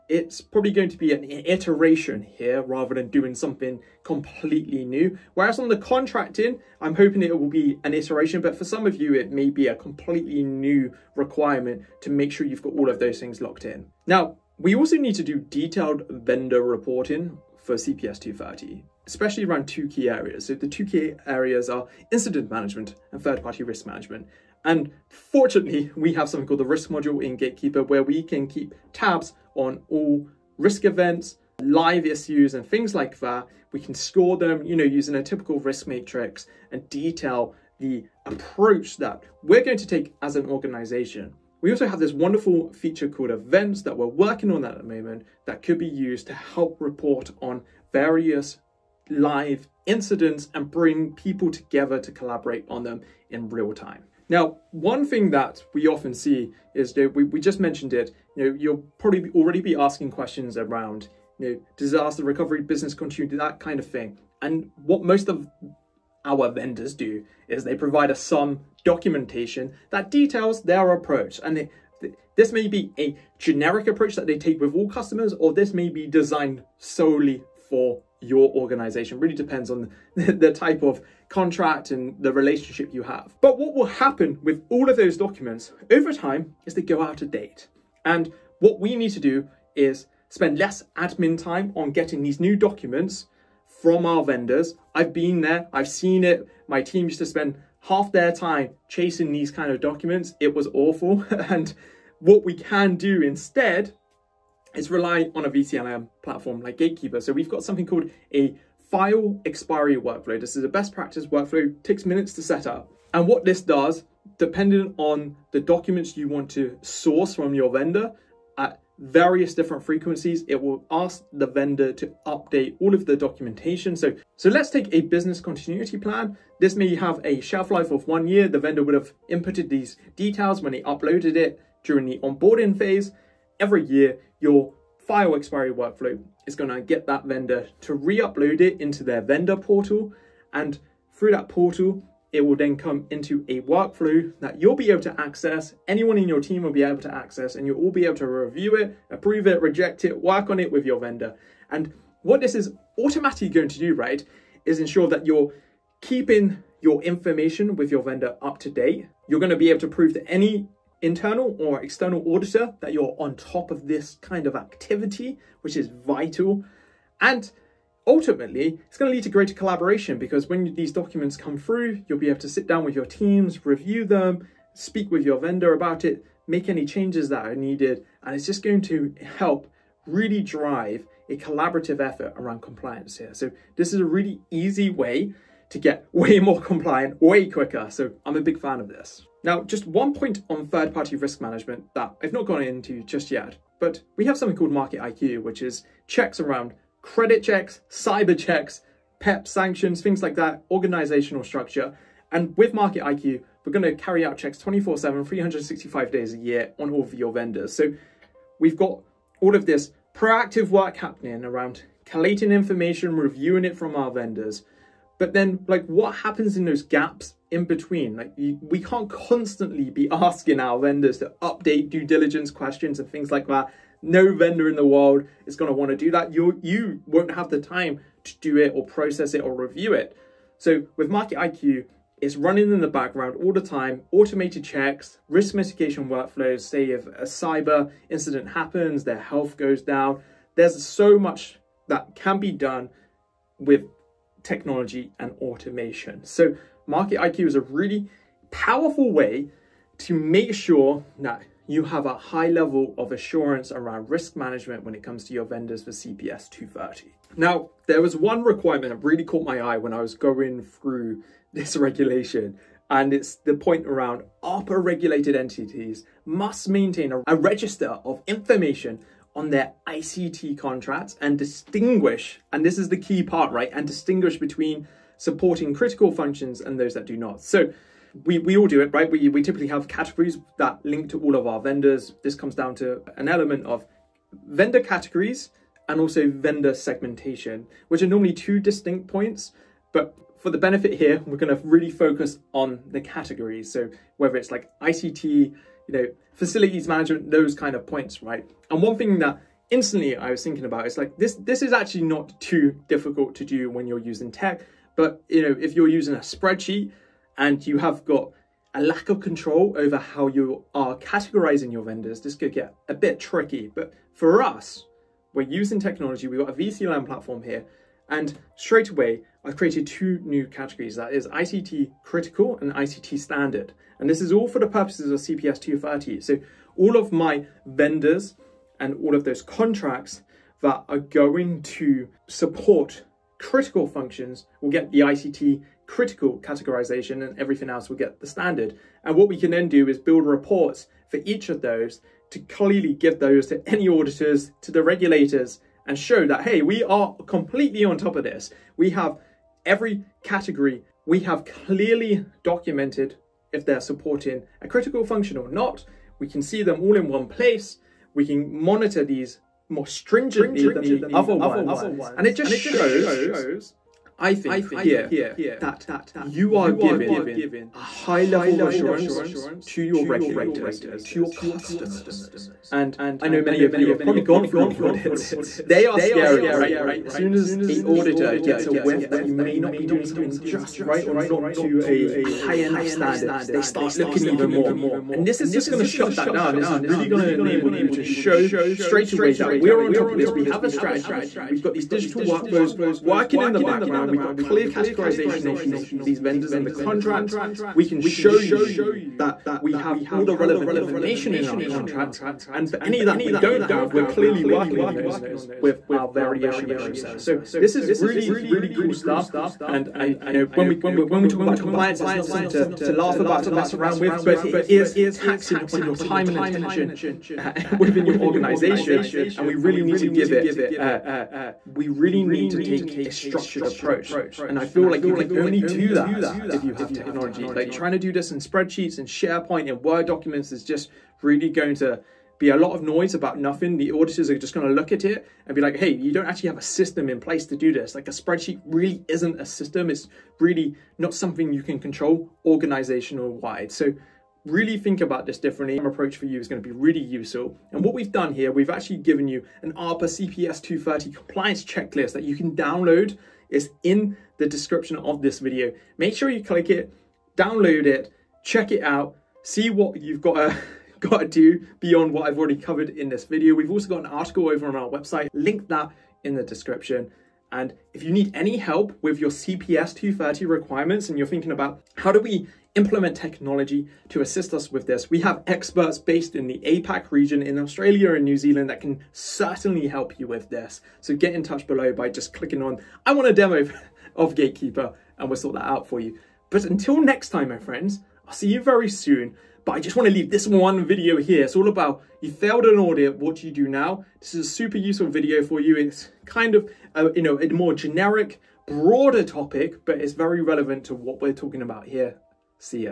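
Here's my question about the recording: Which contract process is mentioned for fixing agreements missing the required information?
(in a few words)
variation process.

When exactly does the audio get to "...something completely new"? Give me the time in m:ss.
0:03.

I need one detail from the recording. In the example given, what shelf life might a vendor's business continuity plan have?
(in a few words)
1 year.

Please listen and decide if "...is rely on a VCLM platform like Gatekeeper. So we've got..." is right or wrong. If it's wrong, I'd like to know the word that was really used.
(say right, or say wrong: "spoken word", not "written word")
right.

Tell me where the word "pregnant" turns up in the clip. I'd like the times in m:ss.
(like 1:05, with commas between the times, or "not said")
not said.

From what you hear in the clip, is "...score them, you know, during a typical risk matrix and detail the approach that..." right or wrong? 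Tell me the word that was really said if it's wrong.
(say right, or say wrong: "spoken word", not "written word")
wrong: "using", not "during".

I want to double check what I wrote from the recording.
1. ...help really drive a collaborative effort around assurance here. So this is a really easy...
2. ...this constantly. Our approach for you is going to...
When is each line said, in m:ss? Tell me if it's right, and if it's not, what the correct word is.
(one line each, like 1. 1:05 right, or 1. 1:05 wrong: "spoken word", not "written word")
1. 2:59 wrong: "compliance", not "assurance"
2. 7:25 wrong: "differently", not "constantly".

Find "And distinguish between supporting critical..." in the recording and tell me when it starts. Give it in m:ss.
4:33.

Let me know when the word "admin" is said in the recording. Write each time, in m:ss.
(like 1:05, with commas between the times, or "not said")
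1:30.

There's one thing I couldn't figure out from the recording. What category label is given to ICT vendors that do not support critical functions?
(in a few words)
ICT standard.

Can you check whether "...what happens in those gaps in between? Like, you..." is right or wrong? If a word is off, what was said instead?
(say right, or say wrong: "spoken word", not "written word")
right.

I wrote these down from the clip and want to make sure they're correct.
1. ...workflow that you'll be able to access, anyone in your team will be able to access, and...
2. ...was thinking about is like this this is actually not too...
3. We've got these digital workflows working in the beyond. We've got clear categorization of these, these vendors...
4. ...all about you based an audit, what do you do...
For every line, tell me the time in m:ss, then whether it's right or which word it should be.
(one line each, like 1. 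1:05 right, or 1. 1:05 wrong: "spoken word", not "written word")
1. 2:23 right
2. 5:00 right
3. 6:31 wrong: "background", not "beyond"
4. 8:11 wrong: "failed", not "based".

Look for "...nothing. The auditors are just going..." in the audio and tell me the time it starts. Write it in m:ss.
7:13.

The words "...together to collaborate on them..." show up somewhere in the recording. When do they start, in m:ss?
0:51.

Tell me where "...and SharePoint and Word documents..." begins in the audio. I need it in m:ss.
7:08.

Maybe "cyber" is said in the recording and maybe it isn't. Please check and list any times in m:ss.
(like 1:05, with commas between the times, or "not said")
3:17, 3:57.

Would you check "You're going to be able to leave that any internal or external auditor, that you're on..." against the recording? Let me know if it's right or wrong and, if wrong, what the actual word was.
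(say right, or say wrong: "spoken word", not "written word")
wrong: "prove", not "leave".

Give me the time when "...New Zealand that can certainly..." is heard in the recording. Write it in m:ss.
7:58.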